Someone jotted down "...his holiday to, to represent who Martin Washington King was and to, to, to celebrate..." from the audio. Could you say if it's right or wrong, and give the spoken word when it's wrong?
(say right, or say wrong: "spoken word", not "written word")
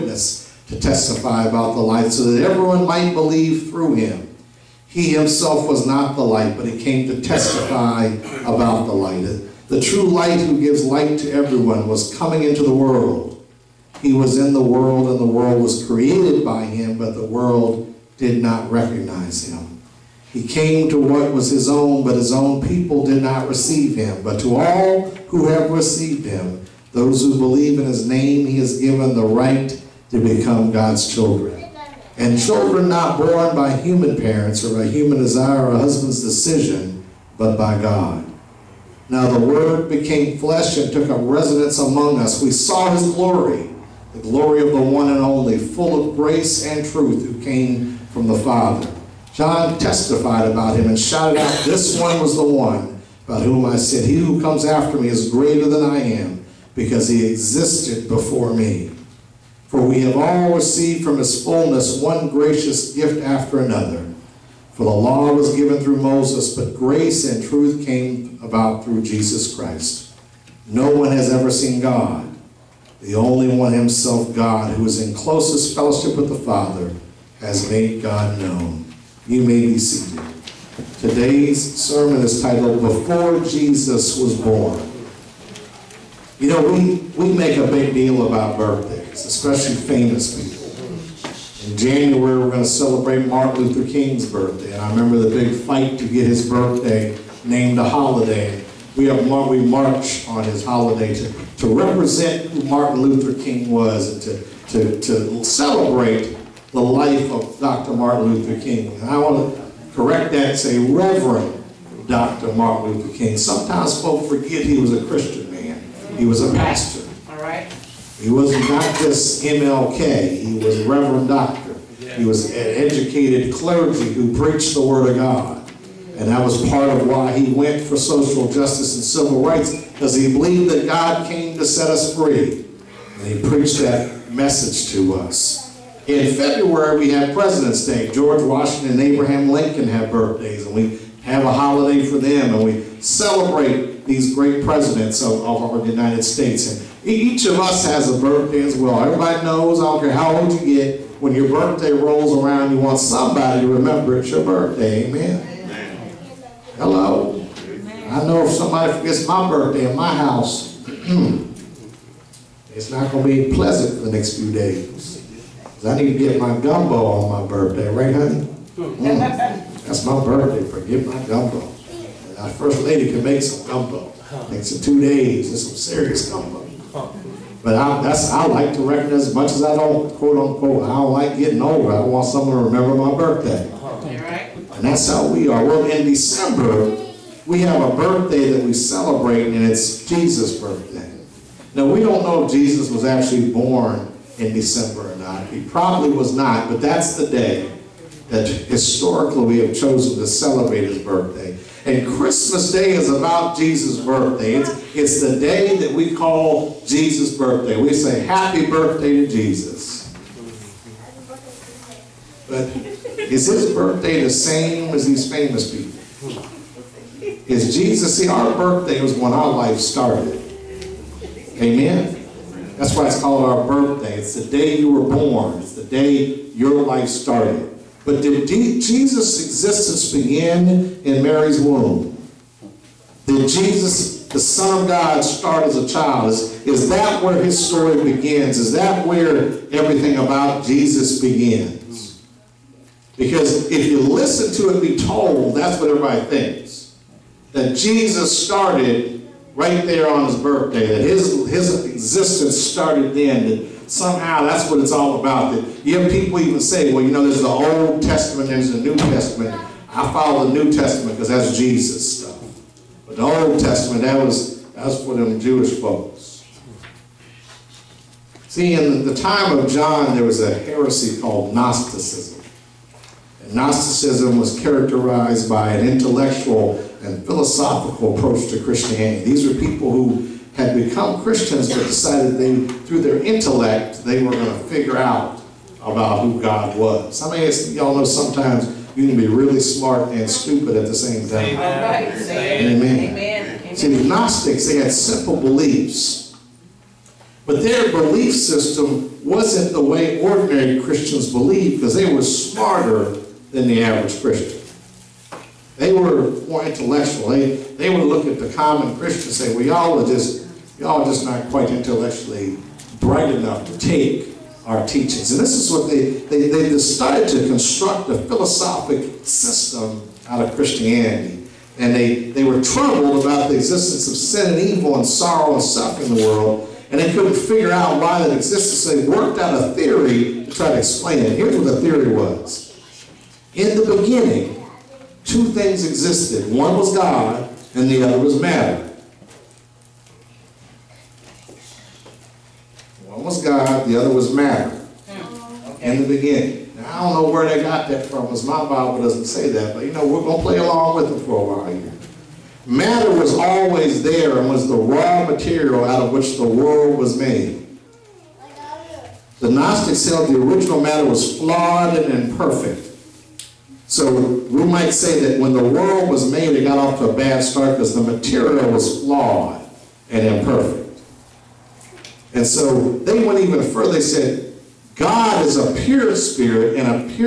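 wrong: "Luther", not "Washington".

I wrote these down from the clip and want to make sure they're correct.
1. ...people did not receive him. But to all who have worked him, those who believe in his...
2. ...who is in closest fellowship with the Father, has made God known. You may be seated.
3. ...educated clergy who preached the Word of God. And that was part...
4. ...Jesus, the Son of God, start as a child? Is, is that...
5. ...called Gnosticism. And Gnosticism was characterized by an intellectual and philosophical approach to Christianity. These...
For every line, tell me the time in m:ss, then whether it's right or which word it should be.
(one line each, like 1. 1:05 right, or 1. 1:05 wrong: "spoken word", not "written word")
1. 0:22 wrong: "received", not "worked"
2. 1:14 right
3. 2:02 right
4. 3:53 right
5. 4:31 right.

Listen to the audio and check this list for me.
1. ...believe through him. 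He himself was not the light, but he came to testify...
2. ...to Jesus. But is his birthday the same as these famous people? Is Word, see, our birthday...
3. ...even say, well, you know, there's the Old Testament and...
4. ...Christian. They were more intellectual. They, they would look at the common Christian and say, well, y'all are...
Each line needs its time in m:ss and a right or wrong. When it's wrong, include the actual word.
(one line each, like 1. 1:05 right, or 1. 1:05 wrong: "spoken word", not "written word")
1. 0:03 right
2. 3:29 wrong: "Jesus", not "Word"
3. 4:16 right
4. 5:04 right.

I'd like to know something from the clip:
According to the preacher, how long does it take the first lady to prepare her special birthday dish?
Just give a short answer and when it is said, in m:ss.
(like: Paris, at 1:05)
2 days, at 2:54.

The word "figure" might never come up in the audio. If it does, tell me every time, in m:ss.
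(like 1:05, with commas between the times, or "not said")
4:44, 5:27.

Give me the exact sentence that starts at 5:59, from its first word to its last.
The Gnostics held the original matter was flawed and imperfect.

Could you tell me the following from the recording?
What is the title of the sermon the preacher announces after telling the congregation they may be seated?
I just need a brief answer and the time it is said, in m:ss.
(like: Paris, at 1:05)
Before Jesus Was Born, at 1:22.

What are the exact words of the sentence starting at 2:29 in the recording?
Everybody knows, I don't care how old you get, when your birthday rolls around, you want somebody to remember it's your birthday.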